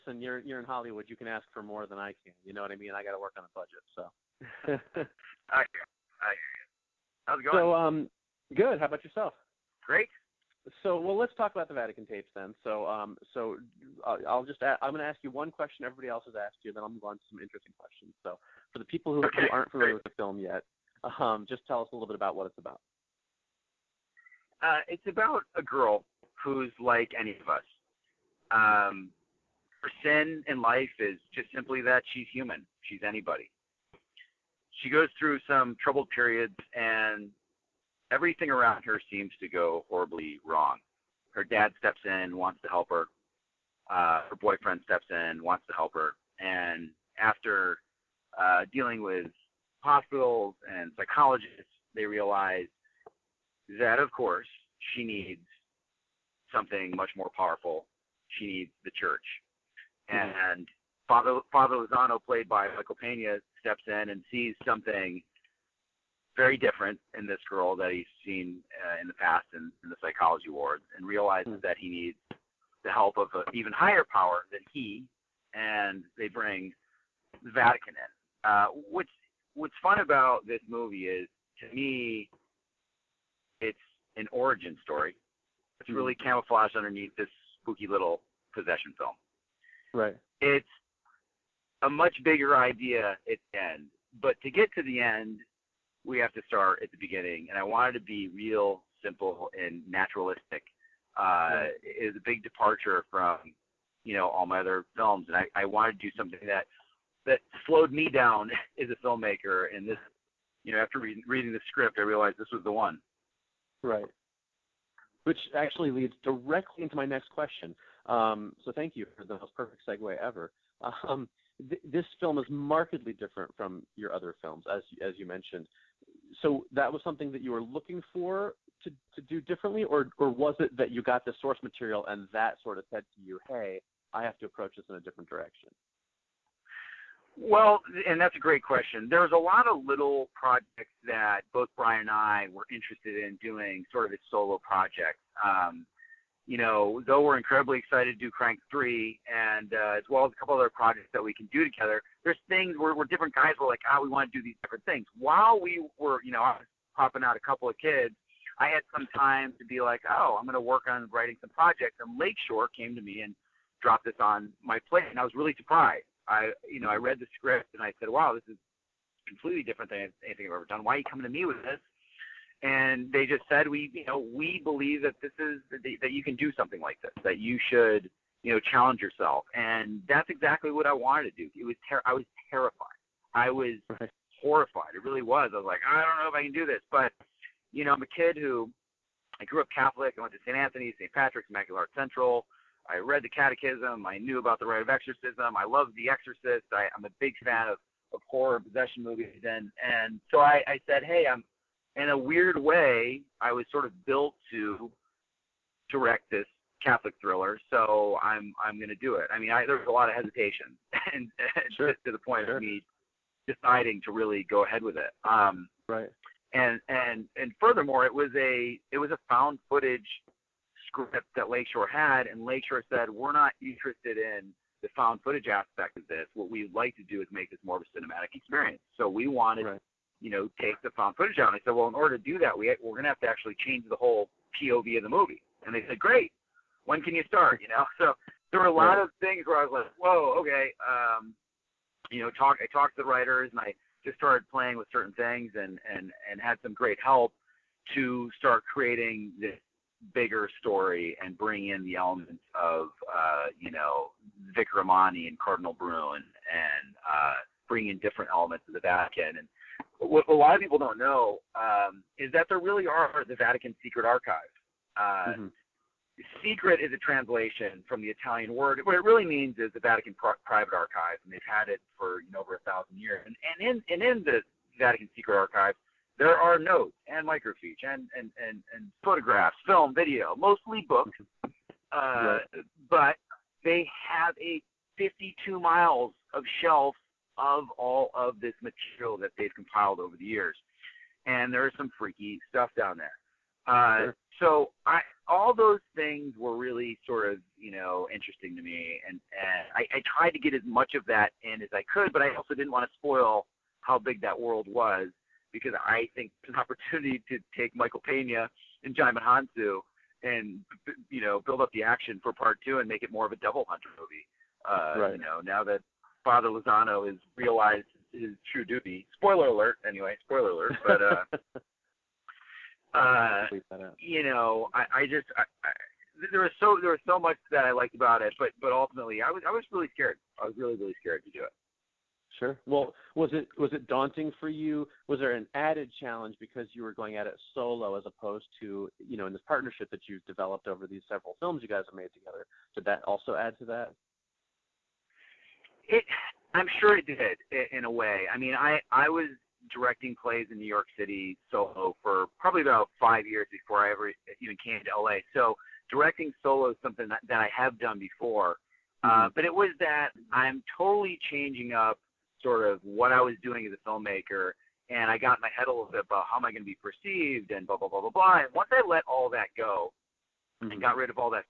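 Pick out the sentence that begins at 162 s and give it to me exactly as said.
And Lakeshore came to me and dropped this on my plate, and I was really surprised.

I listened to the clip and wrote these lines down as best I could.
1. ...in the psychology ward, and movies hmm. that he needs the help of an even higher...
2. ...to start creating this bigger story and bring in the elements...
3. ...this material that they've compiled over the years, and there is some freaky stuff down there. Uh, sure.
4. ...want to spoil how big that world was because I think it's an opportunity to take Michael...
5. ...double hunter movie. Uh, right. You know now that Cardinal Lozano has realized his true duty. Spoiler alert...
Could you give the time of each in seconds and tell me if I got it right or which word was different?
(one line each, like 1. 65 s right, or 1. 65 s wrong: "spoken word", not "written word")
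1. 69 s wrong: "realizes", not "movies"
2. 247 s right
3. 288 s right
4. 302 s right
5. 313 s wrong: "Father", not "Cardinal".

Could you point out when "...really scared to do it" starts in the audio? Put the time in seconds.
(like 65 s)
330 s.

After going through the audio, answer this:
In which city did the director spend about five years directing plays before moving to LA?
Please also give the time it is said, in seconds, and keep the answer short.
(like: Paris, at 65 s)
New York City, at 350 s.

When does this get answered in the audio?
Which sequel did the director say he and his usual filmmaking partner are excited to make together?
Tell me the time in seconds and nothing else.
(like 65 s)
148 s.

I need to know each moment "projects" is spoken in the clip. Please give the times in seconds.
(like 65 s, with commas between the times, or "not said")
140 s, 144 s, 150 s, 161 s.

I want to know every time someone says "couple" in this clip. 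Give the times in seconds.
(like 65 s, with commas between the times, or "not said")
150 s, 157 s.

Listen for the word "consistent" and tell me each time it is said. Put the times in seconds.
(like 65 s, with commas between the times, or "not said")
not said.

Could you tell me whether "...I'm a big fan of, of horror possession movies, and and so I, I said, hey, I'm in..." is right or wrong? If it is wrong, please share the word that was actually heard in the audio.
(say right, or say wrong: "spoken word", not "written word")
right.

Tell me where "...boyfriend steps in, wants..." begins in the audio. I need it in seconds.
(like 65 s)
44 s.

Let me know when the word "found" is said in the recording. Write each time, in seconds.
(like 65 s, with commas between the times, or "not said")
219 s, 224 s, 230 s.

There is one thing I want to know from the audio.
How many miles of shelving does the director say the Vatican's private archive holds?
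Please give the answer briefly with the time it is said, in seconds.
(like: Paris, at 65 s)
52, at 284 s.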